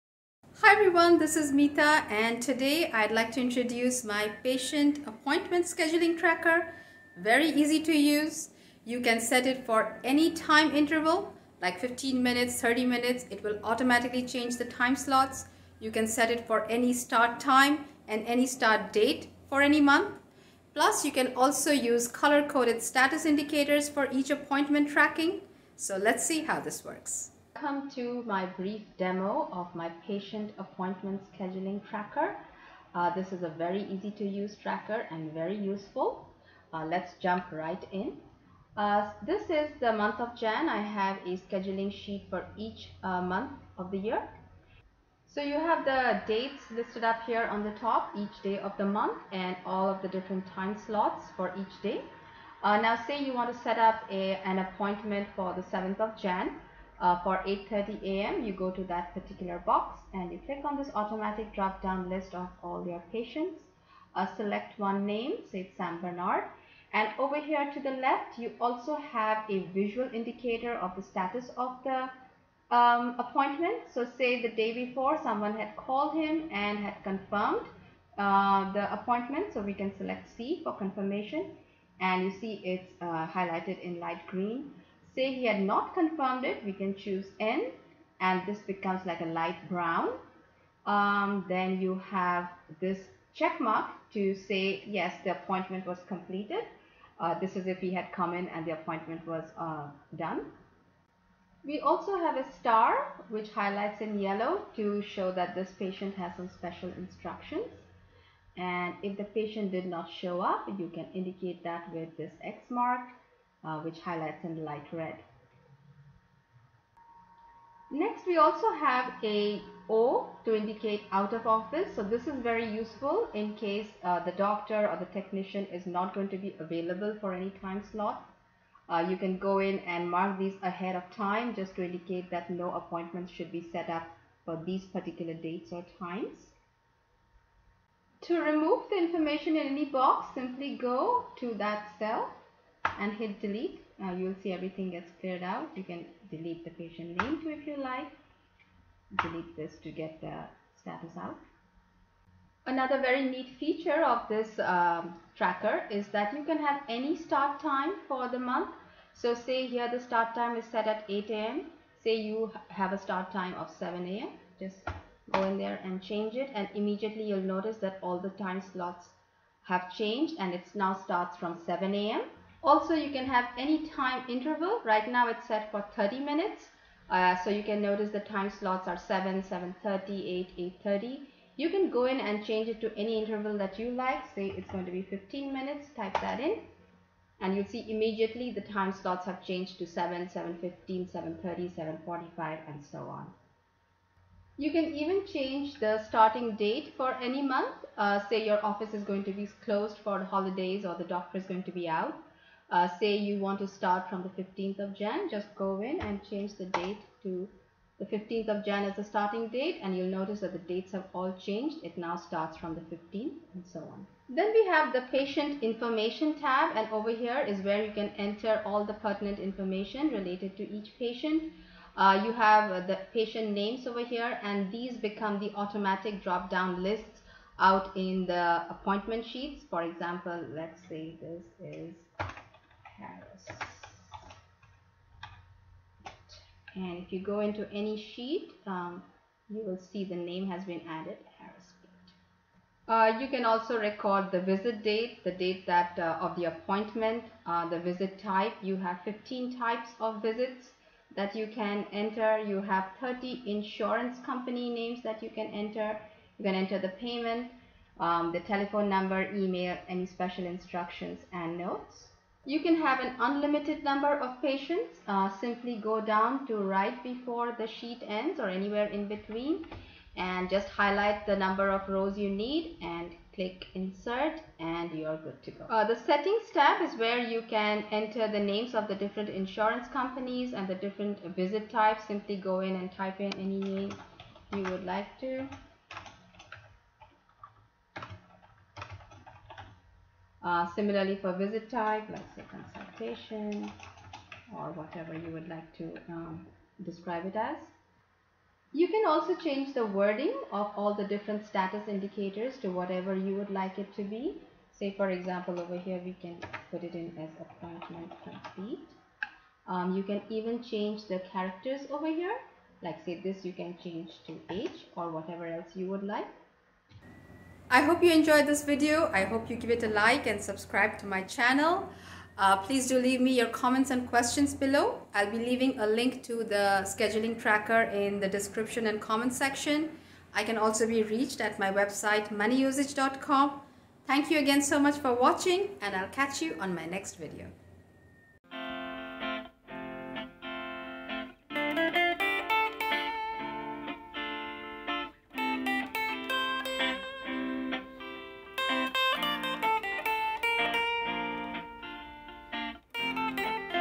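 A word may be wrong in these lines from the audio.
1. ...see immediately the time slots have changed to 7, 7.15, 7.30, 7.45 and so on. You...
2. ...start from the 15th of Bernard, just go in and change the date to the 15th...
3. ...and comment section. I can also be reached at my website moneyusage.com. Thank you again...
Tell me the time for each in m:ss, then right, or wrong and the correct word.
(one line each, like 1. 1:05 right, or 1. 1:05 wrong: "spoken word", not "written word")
1. 3:07 right
2. 3:23 wrong: "Jan", not "Bernard"
3. 5:28 right.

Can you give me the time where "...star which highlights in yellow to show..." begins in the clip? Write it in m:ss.
1:42.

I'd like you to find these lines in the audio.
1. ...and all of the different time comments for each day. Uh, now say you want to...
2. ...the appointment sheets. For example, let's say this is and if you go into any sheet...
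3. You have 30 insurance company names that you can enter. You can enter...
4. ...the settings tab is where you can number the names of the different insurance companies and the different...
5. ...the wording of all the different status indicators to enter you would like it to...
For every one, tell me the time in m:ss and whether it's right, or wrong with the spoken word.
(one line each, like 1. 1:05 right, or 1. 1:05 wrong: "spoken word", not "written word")
1. 0:49 wrong: "slots", not "comments"
2. 3:48 right
3. 4:12 right
4. 4:35 wrong: "enter", not "number"
5. 4:59 wrong: "whatever", not "enter".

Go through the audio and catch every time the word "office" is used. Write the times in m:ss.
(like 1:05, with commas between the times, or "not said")
2:01, 3:18.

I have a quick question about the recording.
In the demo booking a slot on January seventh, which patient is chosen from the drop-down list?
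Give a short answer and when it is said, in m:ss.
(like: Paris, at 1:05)
San Bernard, at 1:05.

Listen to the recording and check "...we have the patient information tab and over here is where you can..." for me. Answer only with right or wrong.
right.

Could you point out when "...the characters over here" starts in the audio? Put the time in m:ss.
5:11.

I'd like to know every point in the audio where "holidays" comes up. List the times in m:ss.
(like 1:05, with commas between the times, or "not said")
3:20.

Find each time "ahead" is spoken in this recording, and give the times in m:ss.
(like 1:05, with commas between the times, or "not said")
2:10.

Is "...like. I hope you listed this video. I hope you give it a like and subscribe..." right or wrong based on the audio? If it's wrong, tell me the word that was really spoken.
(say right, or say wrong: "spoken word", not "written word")
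wrong: "enjoyed", not "listed".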